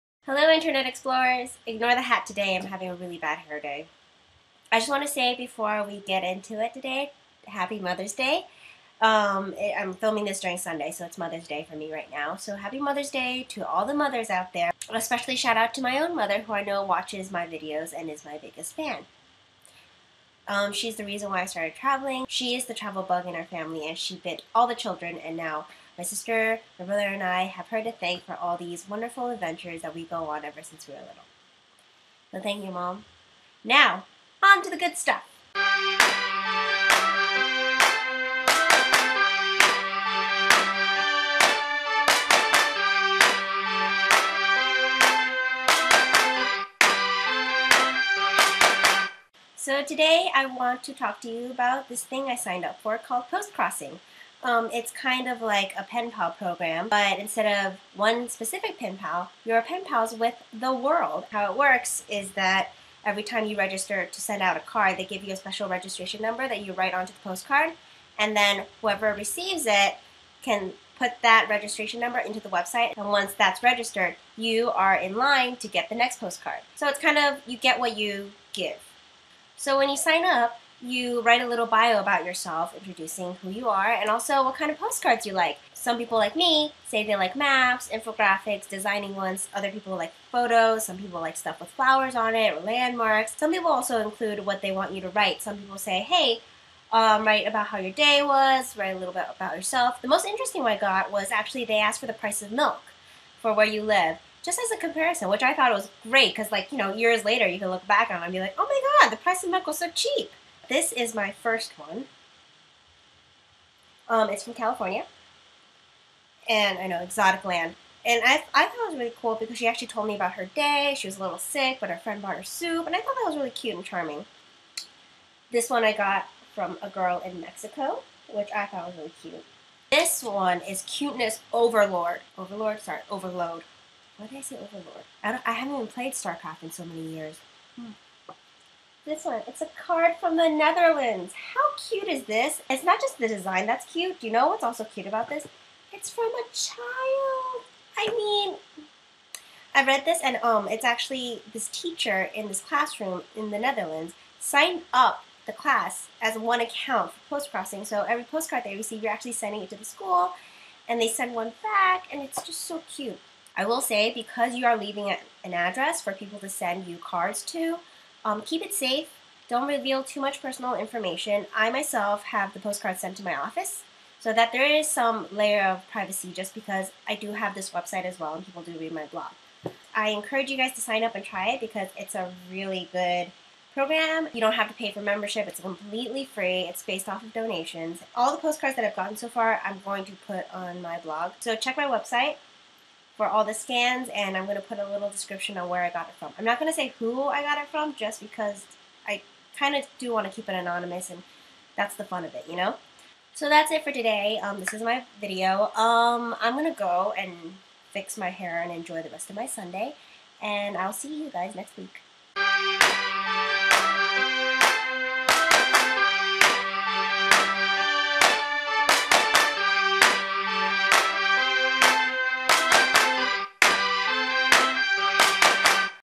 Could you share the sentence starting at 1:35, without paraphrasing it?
Some people say, hey, um, write about how your day was, write a little bit about yourself.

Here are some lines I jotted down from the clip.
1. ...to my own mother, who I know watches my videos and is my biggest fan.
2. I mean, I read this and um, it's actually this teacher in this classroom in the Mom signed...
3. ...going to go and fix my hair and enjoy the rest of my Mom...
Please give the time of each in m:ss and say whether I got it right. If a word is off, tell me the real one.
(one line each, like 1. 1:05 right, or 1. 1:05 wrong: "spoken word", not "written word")
1. 0:15 right
2. 2:27 wrong: "Netherlands", not "Mom"
3. 3:26 wrong: "Sunday", not "Mom".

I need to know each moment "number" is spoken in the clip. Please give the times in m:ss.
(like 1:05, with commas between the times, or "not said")
1:06, 1:11.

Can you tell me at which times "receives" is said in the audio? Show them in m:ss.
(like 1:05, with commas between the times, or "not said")
1:09, 2:38.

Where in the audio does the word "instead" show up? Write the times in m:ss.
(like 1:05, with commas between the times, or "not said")
0:57.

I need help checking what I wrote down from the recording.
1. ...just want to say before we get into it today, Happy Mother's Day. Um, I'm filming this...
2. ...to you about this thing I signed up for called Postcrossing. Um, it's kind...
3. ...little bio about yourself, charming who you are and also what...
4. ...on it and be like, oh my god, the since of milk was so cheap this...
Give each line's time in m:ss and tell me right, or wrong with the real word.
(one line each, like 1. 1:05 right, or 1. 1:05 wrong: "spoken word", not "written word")
1. 0:04 right
2. 0:51 right
3. 1:21 wrong: "introducing", not "charming"
4. 1:48 wrong: "price", not "since".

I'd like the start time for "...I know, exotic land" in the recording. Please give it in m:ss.
1:56.